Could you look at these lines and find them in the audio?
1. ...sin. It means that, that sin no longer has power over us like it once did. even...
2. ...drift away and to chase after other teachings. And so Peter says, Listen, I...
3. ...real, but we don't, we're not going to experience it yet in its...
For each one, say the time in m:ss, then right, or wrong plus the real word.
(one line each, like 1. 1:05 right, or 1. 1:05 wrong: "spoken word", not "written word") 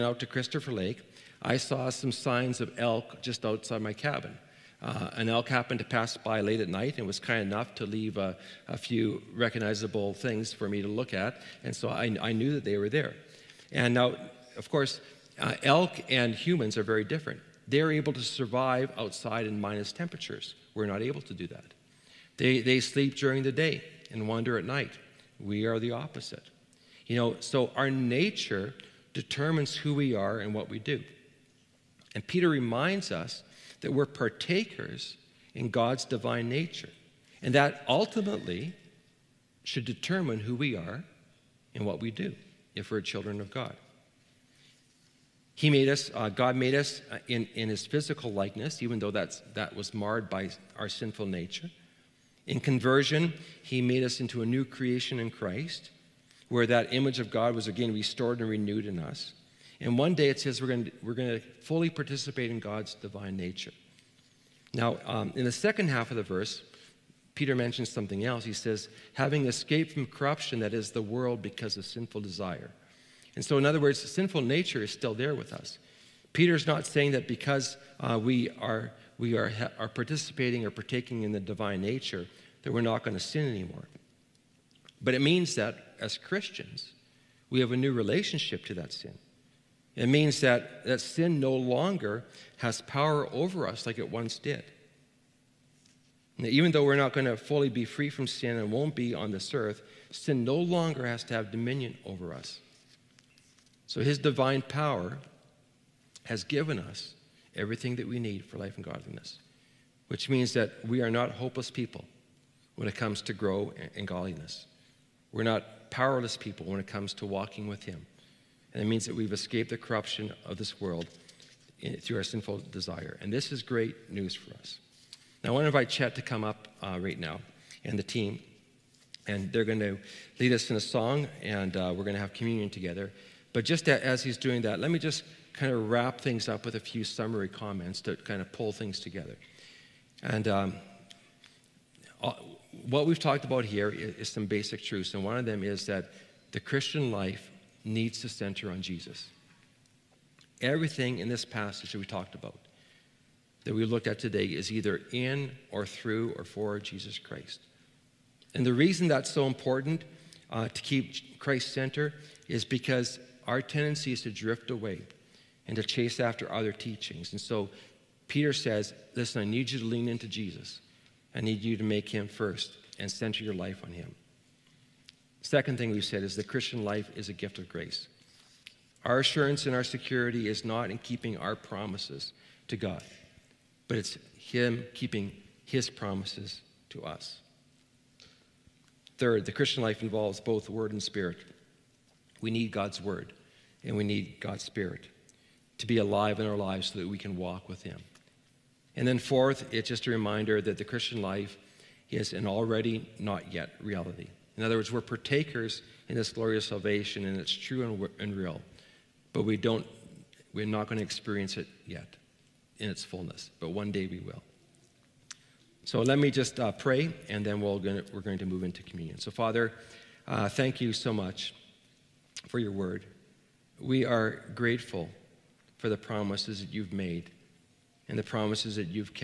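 1. 1:28 right
2. 2:44 right
3. 3:28 right.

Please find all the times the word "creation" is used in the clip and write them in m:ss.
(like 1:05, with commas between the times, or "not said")
0:54.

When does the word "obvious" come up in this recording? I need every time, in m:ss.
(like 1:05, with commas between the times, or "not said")
not said.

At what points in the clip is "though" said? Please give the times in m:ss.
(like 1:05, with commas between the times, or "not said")
0:48, 1:36.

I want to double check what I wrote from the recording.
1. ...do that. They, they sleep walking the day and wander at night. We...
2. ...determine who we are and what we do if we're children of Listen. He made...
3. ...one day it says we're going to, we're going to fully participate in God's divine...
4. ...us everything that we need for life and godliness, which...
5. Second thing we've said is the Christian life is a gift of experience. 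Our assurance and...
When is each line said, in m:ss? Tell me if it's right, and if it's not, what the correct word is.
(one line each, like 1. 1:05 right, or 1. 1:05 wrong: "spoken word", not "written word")
1. 0:21 wrong: "during", not "walking"
2. 0:39 wrong: "God", not "Listen"
3. 0:59 right
4. 1:46 right
5. 2:55 wrong: "grace", not "experience".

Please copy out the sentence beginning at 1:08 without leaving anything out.
He says, having escaped from corruption that is the world because of sinful desire.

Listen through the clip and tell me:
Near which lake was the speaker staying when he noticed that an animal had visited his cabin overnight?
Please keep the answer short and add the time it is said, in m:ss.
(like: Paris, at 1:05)
Christopher Lake, at 0:00.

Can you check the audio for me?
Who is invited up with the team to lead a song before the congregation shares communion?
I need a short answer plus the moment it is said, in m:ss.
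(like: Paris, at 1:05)
Chet, at 2:05.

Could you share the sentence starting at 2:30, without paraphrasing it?
Everything in this passage that we talked about, that we looked at today, is either in or through or for Jesus Christ.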